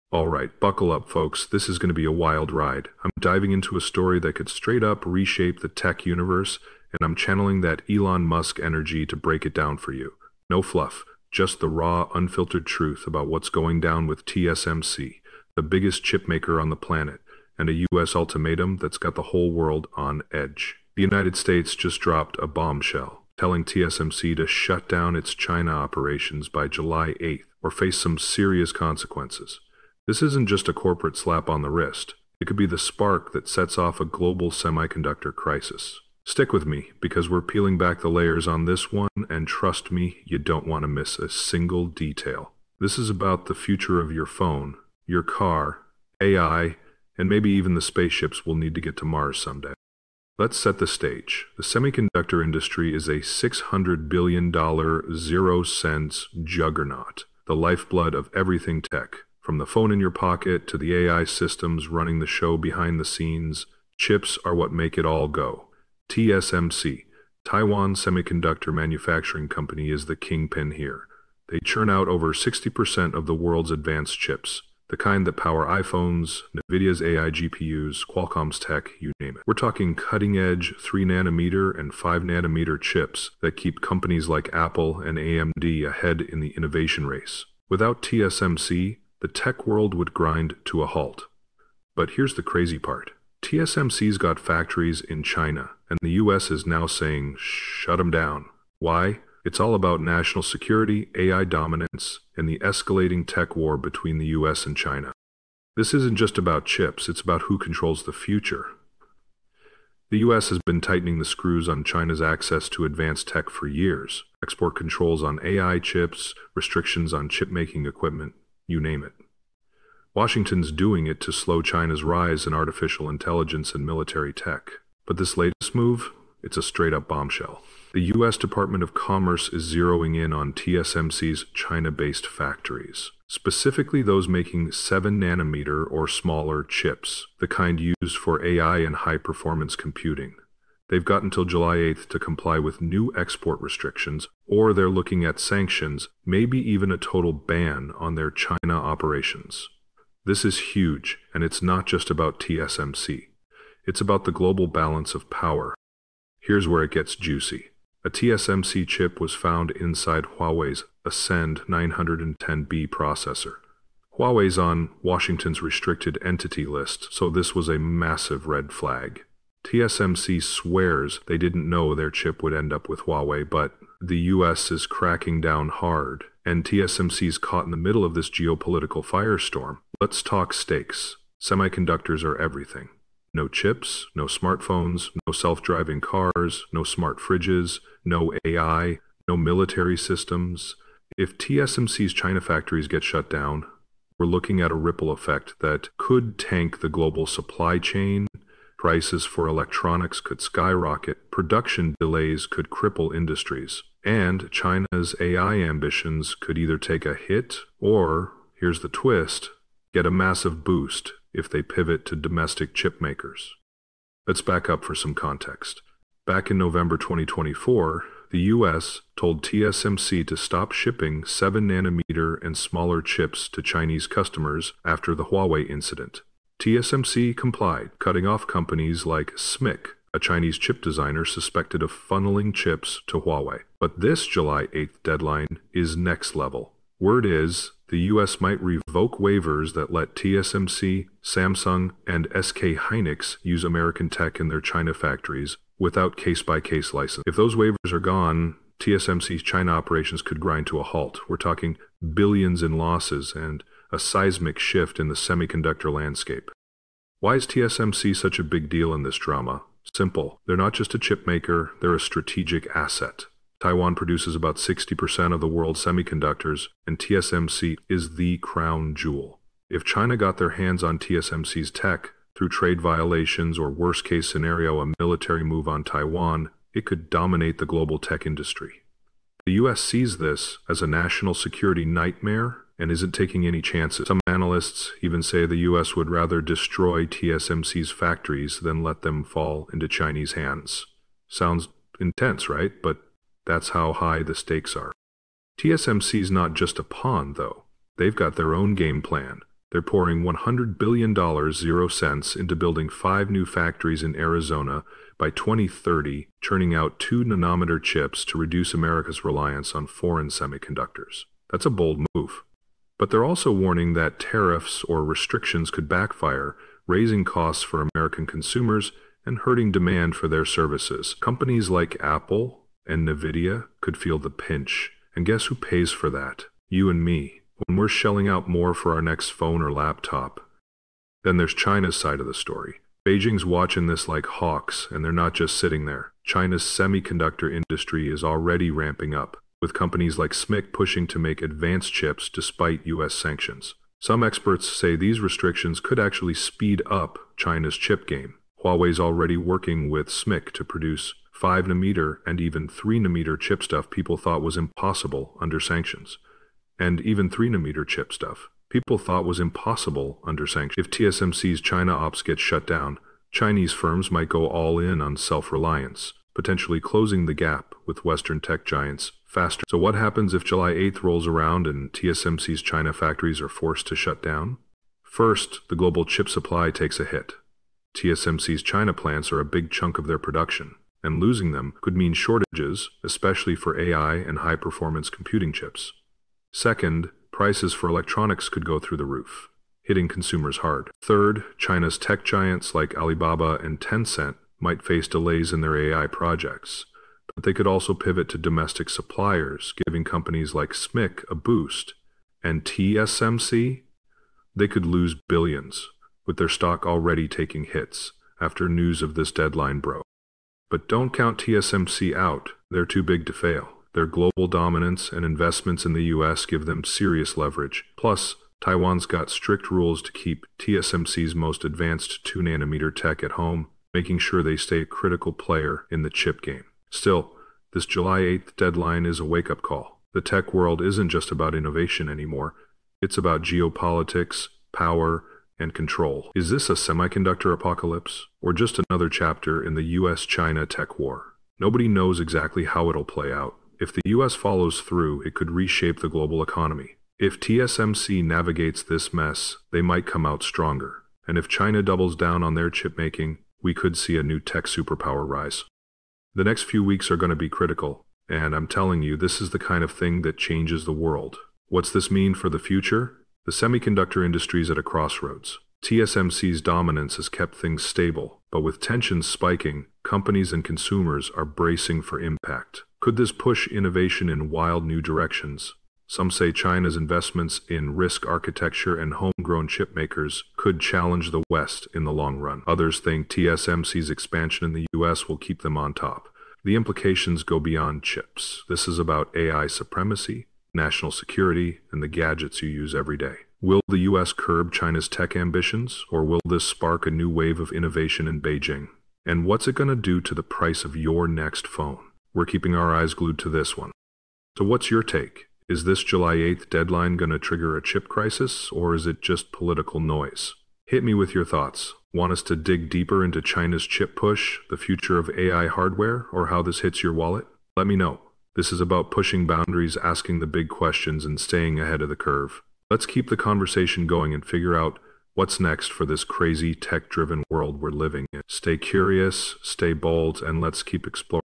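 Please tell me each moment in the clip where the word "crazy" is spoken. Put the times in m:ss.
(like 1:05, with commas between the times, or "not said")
1:32, 8:46.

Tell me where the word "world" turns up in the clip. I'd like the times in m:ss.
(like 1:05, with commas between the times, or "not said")
0:19, 1:13, 1:29, 4:25, 7:10, 7:40, 8:47.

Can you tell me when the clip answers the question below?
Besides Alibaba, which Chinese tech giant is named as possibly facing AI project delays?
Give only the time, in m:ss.
6:33.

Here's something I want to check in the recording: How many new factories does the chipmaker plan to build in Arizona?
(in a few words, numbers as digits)
5.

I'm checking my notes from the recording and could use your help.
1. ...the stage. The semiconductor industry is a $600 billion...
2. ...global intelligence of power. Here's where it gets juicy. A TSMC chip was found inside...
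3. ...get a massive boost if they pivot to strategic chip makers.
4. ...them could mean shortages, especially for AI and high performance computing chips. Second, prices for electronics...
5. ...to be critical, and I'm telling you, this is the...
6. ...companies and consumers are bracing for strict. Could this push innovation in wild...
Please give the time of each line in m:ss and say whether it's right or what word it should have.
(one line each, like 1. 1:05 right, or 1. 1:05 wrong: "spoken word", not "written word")
1. 0:50 right
2. 2:34 wrong: "balance", not "intelligence"
3. 3:29 wrong: "domestic", not "strategic"
4. 6:21 right
5. 7:37 right
6. 7:50 wrong: "impact", not "strict".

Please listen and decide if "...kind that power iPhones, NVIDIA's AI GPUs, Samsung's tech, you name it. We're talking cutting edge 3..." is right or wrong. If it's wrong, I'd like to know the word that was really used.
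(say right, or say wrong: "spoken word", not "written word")
wrong: "Qualcomm", not "Samsung".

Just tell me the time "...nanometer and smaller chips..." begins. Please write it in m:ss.
3:41.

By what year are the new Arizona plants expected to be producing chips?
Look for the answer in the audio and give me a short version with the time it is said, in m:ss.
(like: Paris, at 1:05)
2030, at 5:05.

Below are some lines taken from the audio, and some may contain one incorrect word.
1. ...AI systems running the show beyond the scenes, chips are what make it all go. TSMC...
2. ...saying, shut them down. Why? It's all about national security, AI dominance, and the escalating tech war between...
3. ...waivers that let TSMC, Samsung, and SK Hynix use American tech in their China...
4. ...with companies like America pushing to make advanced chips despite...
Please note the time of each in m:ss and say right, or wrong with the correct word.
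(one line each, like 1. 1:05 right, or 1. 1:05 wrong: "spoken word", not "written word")
1. 1:00 wrong: "behind", not "beyond"
2. 1:36 right
3. 3:59 right
4. 5:39 wrong: "SMIC", not "America".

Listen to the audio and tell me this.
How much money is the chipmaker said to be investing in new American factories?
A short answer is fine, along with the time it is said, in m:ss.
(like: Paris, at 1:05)
$100 billion, at 5:00.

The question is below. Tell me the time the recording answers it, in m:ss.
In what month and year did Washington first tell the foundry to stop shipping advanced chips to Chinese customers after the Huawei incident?
3:36.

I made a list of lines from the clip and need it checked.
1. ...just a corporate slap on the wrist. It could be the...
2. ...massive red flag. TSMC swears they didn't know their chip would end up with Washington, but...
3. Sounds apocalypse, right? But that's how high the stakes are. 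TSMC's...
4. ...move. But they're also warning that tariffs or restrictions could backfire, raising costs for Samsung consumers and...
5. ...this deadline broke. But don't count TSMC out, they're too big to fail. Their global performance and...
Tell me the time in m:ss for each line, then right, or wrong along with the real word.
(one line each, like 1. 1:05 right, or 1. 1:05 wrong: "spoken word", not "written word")
1. 0:30 right
2. 2:47 wrong: "Huawei", not "Washington"
3. 4:51 wrong: "intense", not "apocalypse"
4. 5:12 wrong: "American", not "Samsung"
5. 6:49 wrong: "dominance", not "performance".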